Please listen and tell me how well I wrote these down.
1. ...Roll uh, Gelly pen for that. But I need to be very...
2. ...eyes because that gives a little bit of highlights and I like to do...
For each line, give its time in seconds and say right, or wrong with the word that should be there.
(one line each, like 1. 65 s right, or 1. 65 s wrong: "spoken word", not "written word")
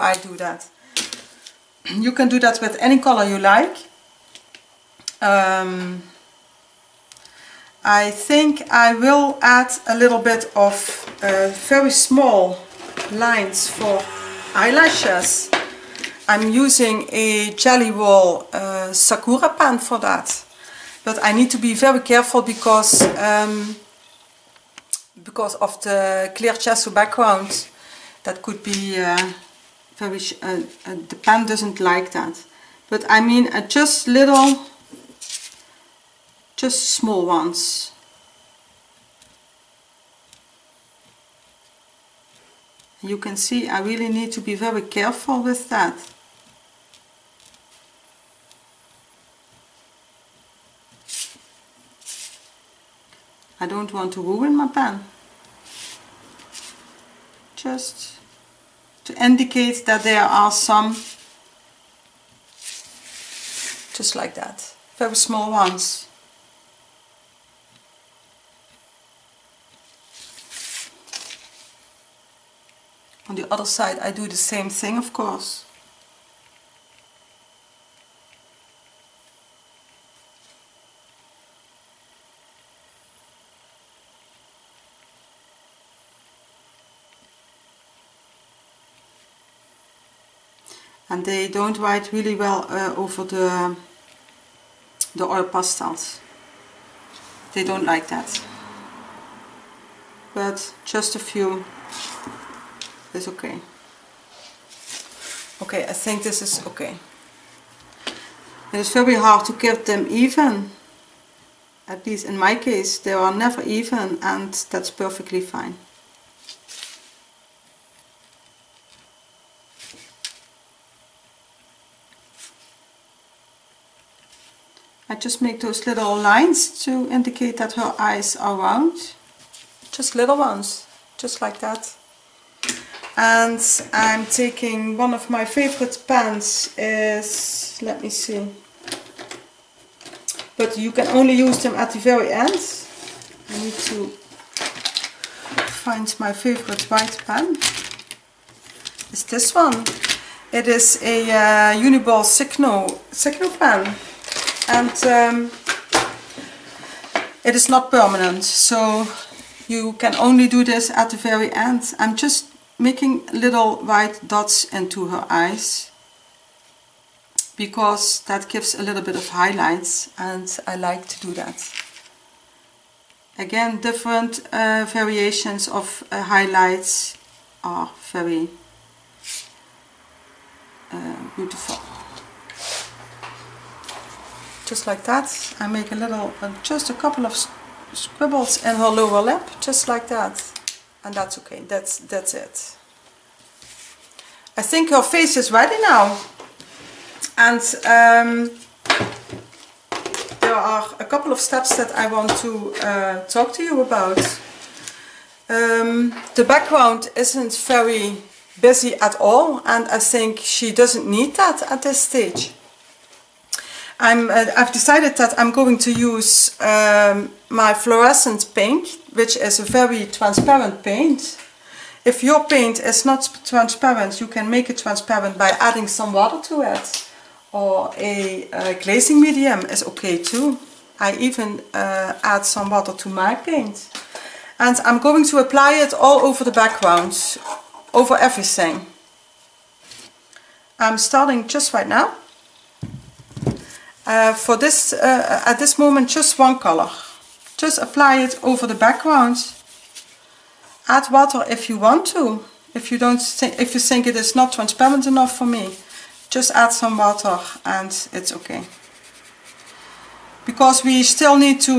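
1. 17 s wrong: "Sakura", not "Gelly"
2. 165 s right.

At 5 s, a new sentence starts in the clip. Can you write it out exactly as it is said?
Um, I think I will add a little bit of uh, very small lines for eyelashes.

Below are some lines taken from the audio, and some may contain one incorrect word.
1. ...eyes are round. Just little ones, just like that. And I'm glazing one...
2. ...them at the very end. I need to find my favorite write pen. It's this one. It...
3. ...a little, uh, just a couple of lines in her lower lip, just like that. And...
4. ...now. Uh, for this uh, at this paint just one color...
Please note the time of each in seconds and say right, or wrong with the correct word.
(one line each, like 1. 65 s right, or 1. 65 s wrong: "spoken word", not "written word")
1. 127 s wrong: "taking", not "glazing"
2. 141 s wrong: "white", not "write"
3. 185 s wrong: "scribbles", not "lines"
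4. 241 s wrong: "moment", not "paint".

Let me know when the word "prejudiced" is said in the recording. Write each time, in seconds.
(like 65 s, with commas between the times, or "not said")
not said.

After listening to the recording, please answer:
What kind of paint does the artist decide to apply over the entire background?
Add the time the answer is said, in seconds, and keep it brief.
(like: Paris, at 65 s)
Fluorescent paint, at 217 s.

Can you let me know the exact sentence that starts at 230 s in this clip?
I even uh, add some water to my paint.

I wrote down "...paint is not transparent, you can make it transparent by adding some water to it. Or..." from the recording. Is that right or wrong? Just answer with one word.
right.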